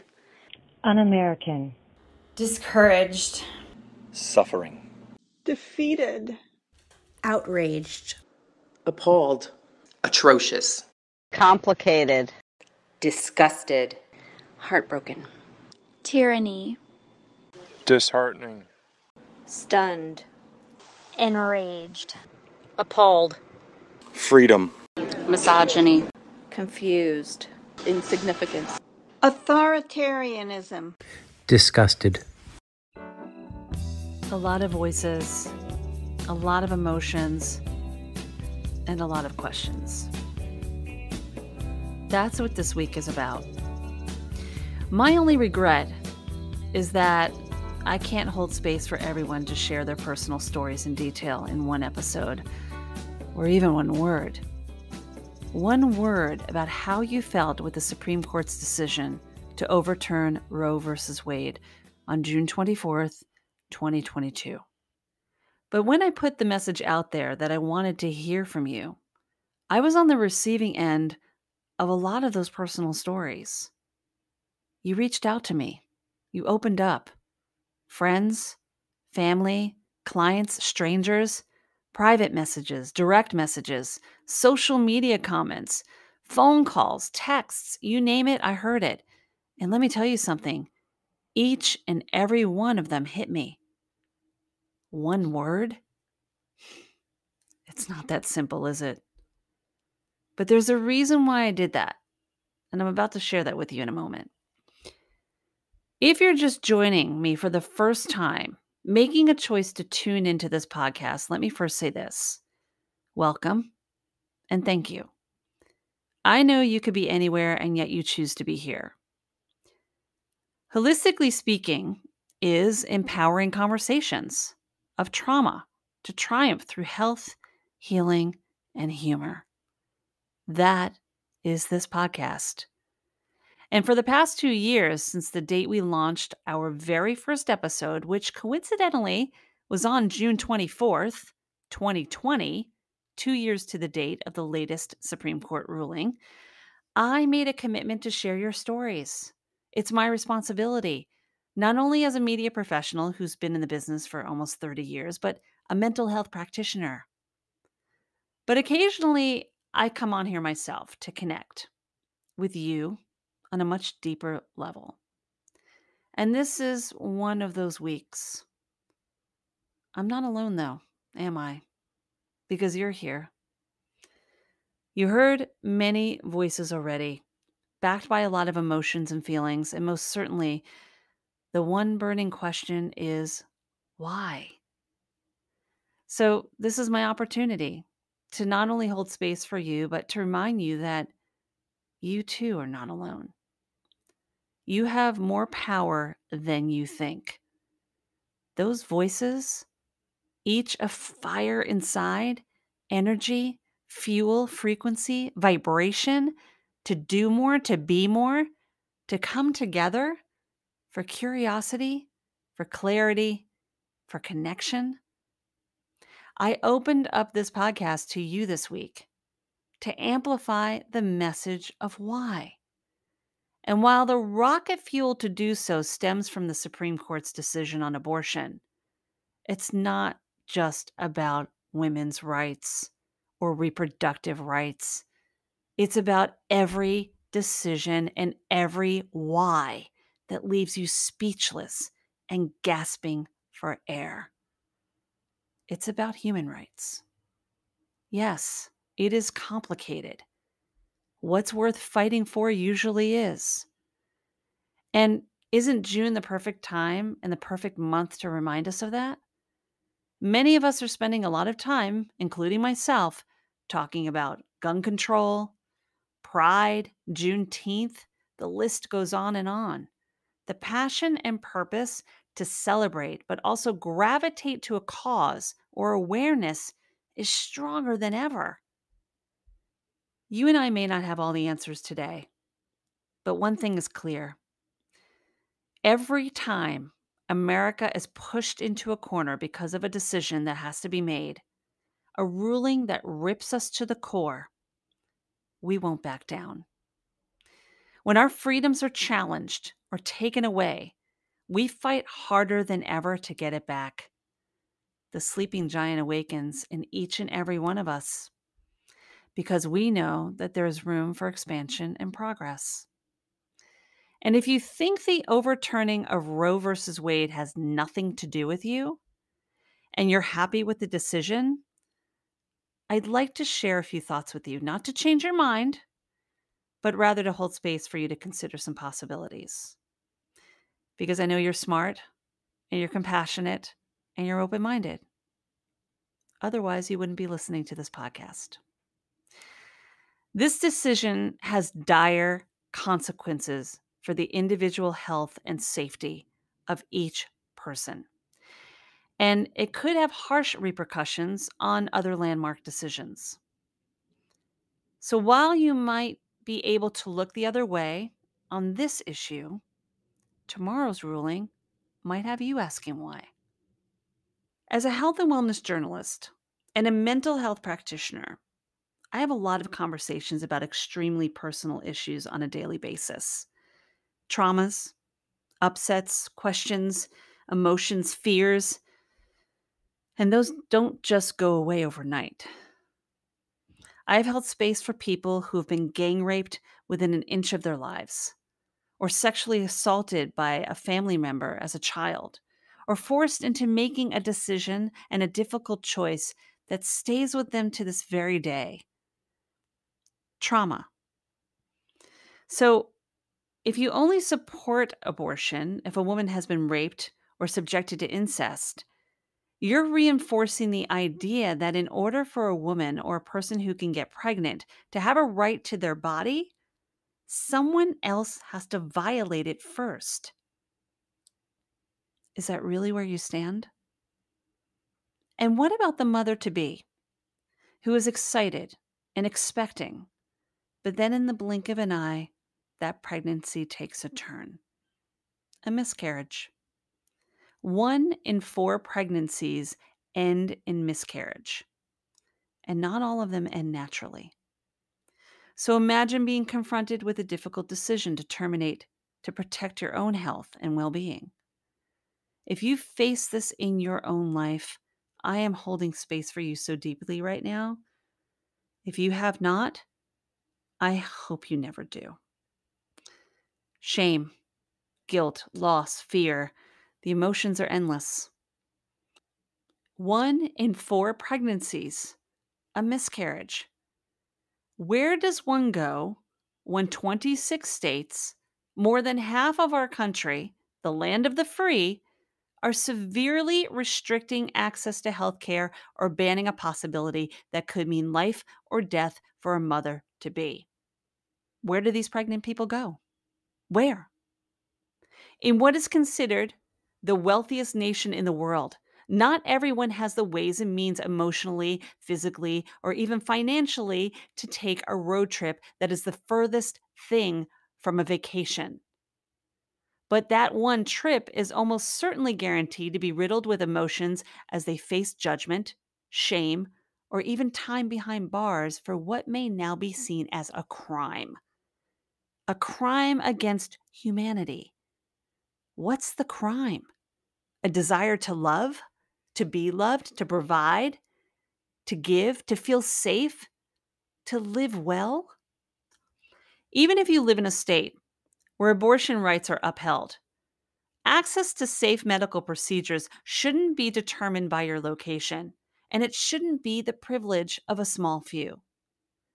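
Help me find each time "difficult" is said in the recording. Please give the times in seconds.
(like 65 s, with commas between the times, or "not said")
395 s, 447 s.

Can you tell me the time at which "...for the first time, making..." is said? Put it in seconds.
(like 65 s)
107 s.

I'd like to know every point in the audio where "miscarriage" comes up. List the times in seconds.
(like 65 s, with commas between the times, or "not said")
435 s, 440 s, 472 s.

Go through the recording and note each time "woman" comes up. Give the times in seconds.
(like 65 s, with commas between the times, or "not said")
406 s, 412 s.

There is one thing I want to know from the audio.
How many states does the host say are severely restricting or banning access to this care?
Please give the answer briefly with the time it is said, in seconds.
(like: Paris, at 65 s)
26, at 476 s.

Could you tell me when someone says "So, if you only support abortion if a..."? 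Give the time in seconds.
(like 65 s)
402 s.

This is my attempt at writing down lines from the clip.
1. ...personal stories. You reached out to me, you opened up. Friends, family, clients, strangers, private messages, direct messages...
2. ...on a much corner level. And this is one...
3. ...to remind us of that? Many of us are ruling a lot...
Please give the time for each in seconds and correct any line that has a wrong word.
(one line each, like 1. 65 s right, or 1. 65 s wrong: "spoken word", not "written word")
1. 72 s right
2. 163 s wrong: "deeper", not "corner"
3. 258 s wrong: "spending", not "ruling".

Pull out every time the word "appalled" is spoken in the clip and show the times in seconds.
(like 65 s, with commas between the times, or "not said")
8 s, 22 s.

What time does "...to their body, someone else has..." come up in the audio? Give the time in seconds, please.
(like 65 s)
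415 s.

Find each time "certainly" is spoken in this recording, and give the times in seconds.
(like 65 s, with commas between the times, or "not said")
180 s, 511 s.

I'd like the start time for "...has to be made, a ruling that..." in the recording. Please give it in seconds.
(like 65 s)
290 s.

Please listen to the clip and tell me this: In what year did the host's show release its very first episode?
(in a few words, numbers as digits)
2020.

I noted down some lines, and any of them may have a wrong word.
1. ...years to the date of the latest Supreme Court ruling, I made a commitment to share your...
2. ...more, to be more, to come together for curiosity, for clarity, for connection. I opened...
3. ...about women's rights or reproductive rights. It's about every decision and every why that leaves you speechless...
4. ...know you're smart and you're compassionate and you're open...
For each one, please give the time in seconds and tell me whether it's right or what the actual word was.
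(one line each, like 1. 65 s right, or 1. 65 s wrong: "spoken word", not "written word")
1. 143 s right
2. 207 s right
3. 230 s right
4. 331 s right.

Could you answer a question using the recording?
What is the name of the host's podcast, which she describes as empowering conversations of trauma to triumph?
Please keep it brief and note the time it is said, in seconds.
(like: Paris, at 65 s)
HIListically Speaking, at 120 s.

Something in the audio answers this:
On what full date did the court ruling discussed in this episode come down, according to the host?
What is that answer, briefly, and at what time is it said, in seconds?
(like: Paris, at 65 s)
June 24th, 2022, at 62 s.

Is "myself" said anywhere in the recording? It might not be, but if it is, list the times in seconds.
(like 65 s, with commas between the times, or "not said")
160 s, 262 s.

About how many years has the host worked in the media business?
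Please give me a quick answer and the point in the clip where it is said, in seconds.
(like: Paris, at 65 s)
almost 30 years, at 154 s.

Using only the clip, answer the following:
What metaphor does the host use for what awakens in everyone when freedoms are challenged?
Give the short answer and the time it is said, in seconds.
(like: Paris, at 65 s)
The sleeping giant, at 305 s.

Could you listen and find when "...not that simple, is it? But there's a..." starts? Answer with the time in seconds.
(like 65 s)
97 s.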